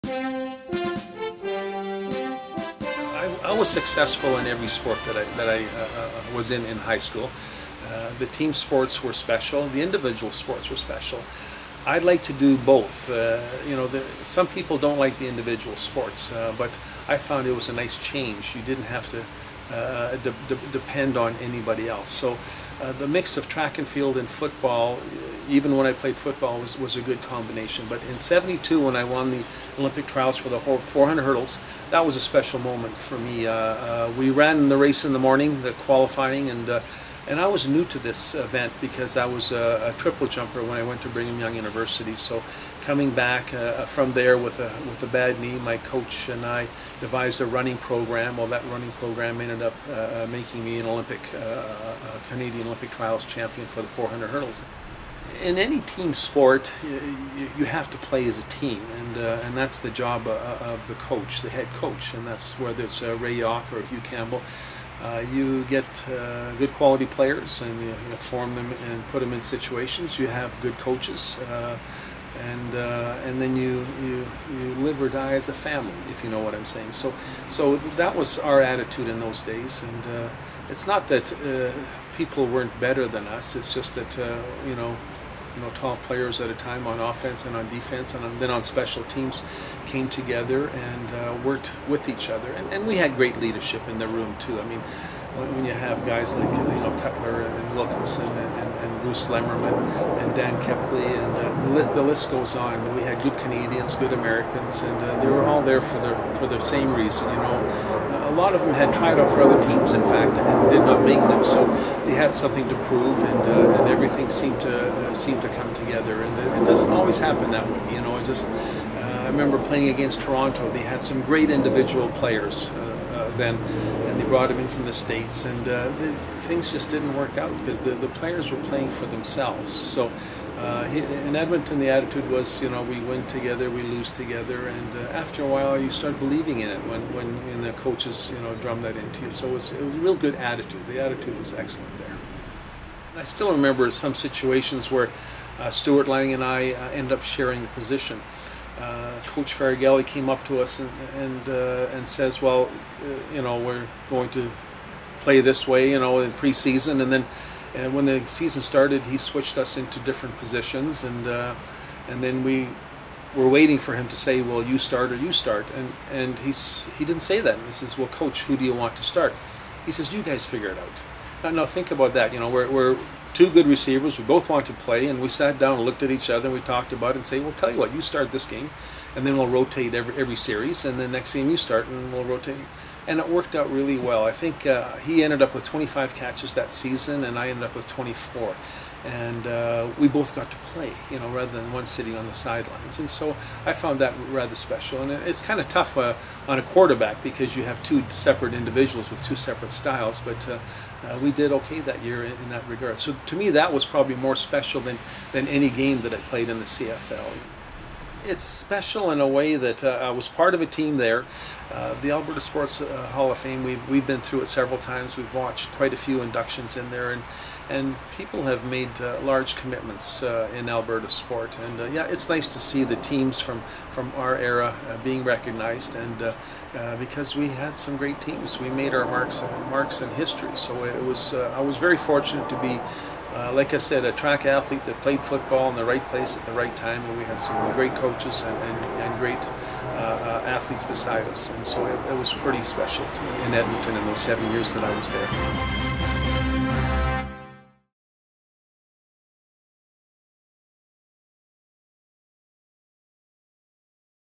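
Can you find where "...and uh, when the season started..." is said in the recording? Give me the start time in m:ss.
2:37.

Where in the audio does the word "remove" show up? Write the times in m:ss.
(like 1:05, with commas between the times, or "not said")
not said.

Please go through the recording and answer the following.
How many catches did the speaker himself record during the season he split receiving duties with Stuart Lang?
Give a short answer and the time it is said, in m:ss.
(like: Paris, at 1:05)
24, at 3:07.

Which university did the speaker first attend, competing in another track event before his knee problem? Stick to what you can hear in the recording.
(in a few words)
Brigham Young University.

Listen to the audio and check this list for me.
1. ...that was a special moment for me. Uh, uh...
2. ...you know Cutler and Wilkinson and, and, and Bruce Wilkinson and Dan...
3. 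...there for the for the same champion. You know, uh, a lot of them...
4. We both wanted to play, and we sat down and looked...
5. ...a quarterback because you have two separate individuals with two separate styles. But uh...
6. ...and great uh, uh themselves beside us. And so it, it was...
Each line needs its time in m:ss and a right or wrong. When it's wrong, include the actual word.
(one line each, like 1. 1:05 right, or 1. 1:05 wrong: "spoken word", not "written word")
1. 0:31 right
2. 1:36 wrong: "Lemmerman", not "Wilkinson"
3. 1:45 wrong: "reason", not "champion"
4. 2:54 right
5. 3:16 right
6. 3:59 wrong: "athletes", not "themselves".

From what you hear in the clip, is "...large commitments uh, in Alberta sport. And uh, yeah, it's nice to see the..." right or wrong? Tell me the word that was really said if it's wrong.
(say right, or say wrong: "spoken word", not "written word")
right.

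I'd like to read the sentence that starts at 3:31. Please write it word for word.
Uh, the Alberta Sports uh, Hall of Fame, we've, we've been through it several times.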